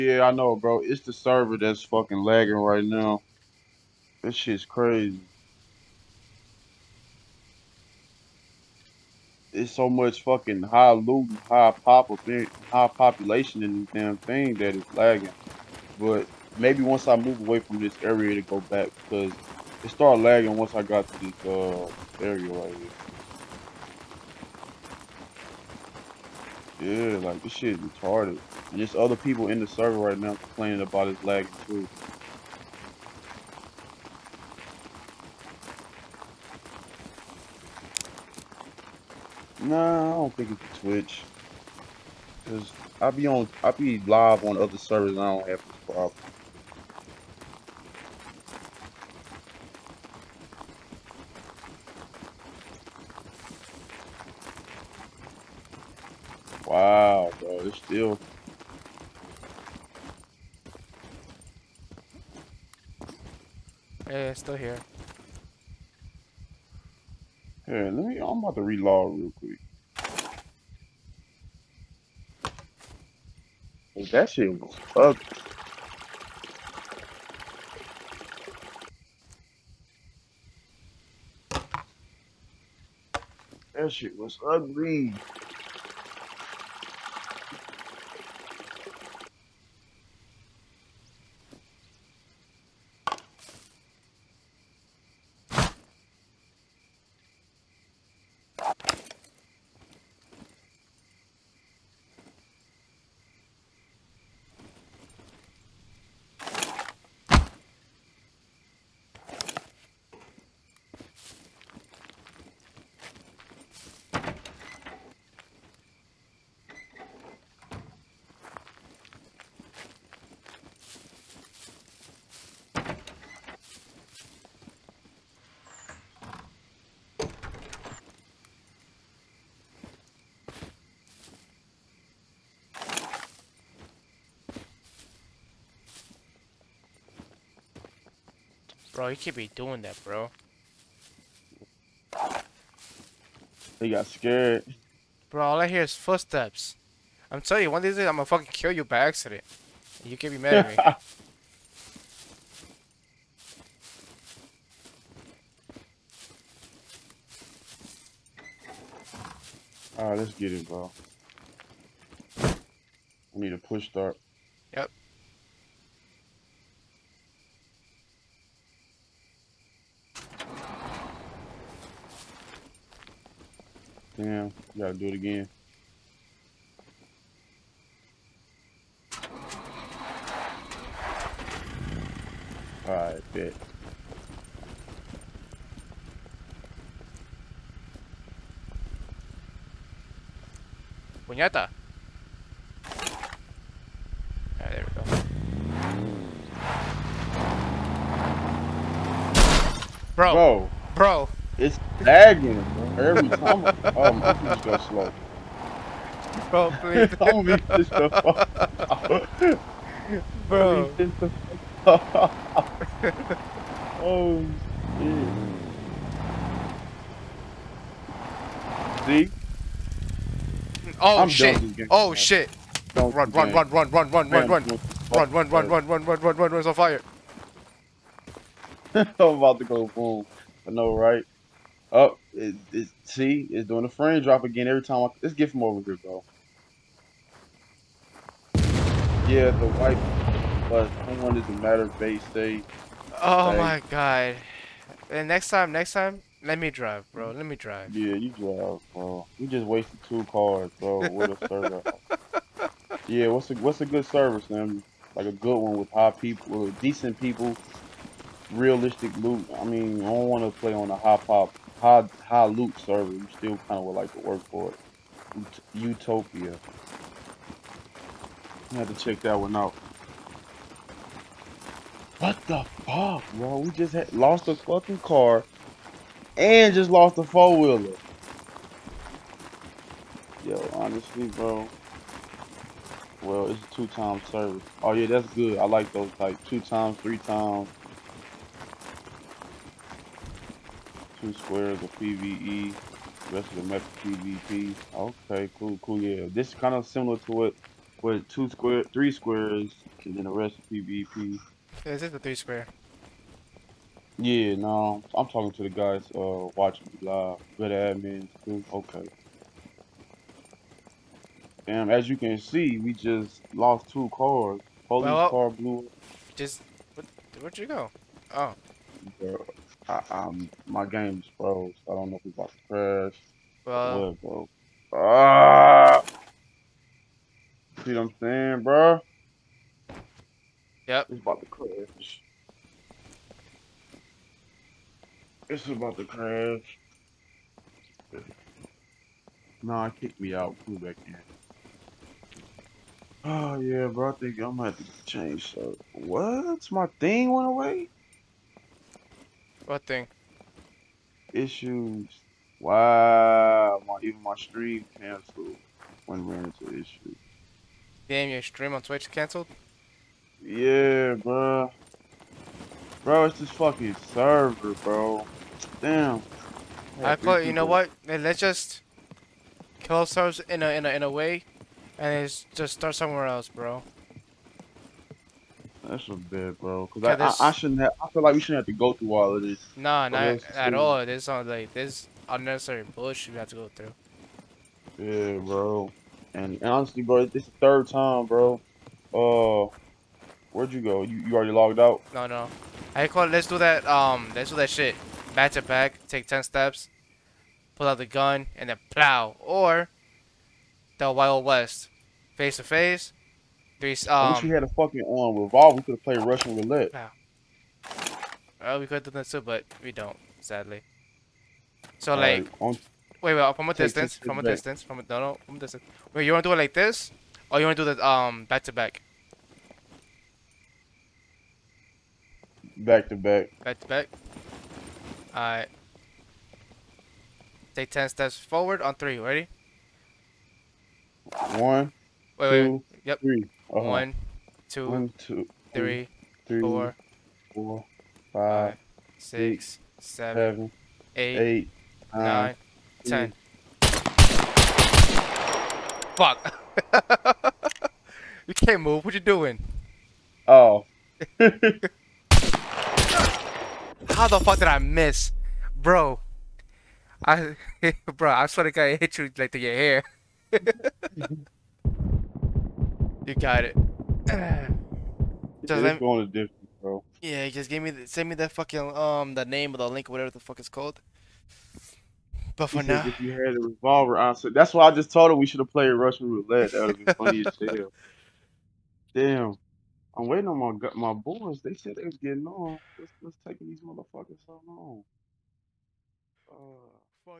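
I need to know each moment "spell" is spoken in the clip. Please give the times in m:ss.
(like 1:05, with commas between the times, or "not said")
not said.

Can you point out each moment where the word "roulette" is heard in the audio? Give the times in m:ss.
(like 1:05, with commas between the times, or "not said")
6:46, 7:56.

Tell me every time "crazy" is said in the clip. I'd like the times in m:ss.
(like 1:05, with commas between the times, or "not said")
0:04.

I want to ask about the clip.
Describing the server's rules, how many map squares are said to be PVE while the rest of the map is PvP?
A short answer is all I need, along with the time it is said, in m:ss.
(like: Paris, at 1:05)
2, at 4:51.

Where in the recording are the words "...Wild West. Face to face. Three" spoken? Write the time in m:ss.
6:41.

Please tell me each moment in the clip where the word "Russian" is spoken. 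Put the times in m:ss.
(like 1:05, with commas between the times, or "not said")
6:46, 7:55.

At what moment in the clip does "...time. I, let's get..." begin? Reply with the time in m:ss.
3:54.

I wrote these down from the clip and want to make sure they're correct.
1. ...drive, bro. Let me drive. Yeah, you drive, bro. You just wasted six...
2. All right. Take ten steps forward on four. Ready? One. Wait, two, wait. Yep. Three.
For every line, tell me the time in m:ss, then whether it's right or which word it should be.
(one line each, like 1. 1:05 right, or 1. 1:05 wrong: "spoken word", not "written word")
1. 4:06 wrong: "two", not "six"
2. 7:05 wrong: "three", not "four".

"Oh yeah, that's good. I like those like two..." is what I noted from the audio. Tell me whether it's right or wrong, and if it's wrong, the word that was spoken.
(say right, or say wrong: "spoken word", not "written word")
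right.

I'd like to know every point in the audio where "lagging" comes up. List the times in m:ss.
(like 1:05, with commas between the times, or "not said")
0:02, 0:14, 0:20, 0:31, 3:22.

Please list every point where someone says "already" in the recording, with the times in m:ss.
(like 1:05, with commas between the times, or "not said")
6:31.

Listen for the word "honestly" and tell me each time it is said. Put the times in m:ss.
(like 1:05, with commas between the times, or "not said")
4:40, 6:26.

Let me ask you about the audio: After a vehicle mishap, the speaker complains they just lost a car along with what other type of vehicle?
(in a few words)
four wheeler.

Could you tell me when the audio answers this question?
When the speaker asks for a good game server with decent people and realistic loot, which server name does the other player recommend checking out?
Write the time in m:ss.
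4:25.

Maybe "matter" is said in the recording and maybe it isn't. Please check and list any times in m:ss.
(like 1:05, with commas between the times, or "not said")
4:01.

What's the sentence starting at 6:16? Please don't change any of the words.
Cause yeah, I, I, I, shouldn't.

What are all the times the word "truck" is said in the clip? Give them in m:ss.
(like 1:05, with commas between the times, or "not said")
not said.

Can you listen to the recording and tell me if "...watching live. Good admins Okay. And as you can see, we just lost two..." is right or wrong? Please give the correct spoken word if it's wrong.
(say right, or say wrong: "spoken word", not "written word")
right.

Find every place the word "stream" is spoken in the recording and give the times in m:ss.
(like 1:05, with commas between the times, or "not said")
5:54, 5:58.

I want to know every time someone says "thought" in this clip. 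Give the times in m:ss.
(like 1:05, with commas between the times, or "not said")
6:07.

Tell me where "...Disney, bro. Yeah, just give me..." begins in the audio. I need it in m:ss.
7:46.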